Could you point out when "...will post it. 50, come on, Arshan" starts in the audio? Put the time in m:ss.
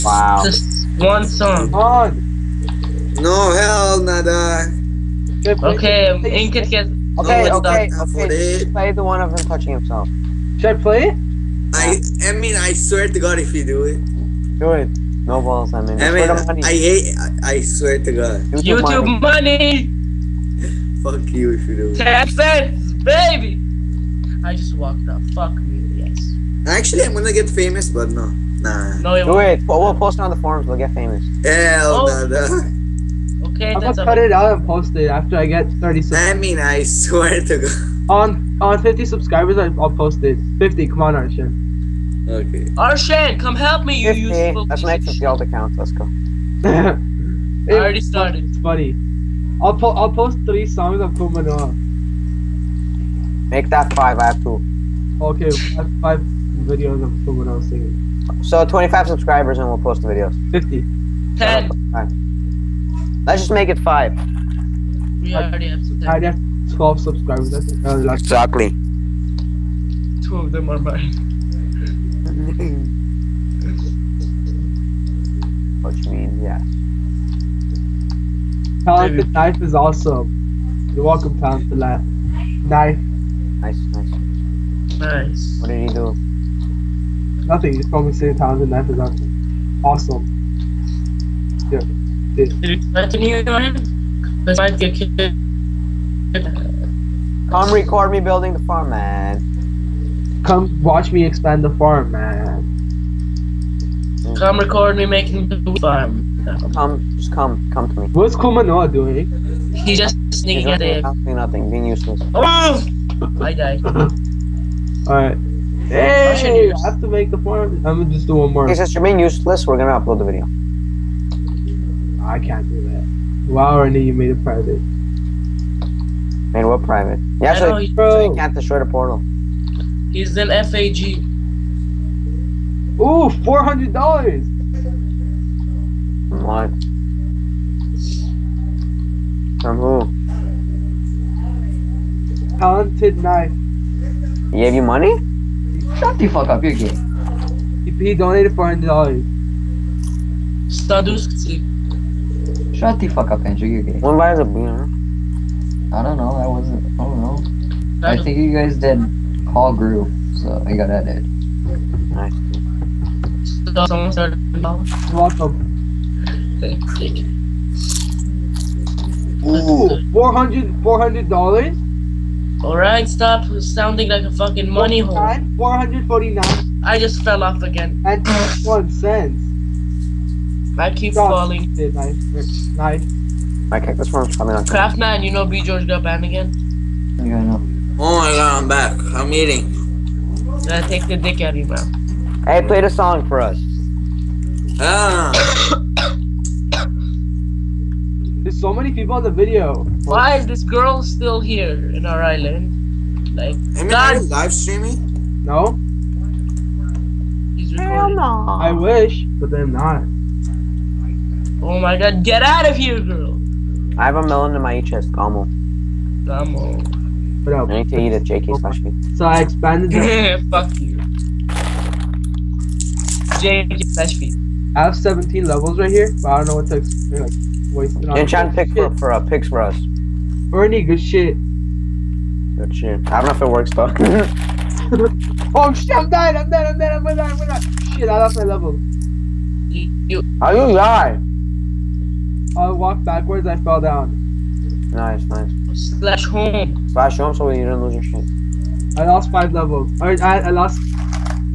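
0:39.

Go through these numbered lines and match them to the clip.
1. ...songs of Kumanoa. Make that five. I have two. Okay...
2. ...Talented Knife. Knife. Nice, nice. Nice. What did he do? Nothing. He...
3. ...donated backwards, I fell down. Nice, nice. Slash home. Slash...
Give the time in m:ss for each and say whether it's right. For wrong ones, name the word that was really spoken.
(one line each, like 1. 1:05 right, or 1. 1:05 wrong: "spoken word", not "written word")
1. 0:50 right
2. 1:21 right
3. 4:02 wrong: "walked", not "donated".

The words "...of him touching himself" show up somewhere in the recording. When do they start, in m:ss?
0:09.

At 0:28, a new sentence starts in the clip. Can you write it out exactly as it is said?
No, it We'll, post it on the forums, we'll get famous.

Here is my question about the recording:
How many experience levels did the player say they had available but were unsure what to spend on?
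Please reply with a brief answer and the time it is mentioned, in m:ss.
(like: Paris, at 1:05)
17, at 3:44.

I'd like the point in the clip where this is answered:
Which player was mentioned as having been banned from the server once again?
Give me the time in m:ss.
3:05.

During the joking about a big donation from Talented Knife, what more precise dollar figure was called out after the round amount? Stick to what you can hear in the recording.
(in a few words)
449.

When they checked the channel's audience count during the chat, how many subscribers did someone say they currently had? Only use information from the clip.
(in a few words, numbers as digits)
12.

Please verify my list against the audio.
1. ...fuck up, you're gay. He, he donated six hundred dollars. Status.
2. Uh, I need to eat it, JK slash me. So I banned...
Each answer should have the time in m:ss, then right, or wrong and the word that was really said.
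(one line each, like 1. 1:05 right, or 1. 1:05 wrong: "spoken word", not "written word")
1. 2:26 wrong: "four", not "six"
2. 3:37 wrong: "expanded", not "banned".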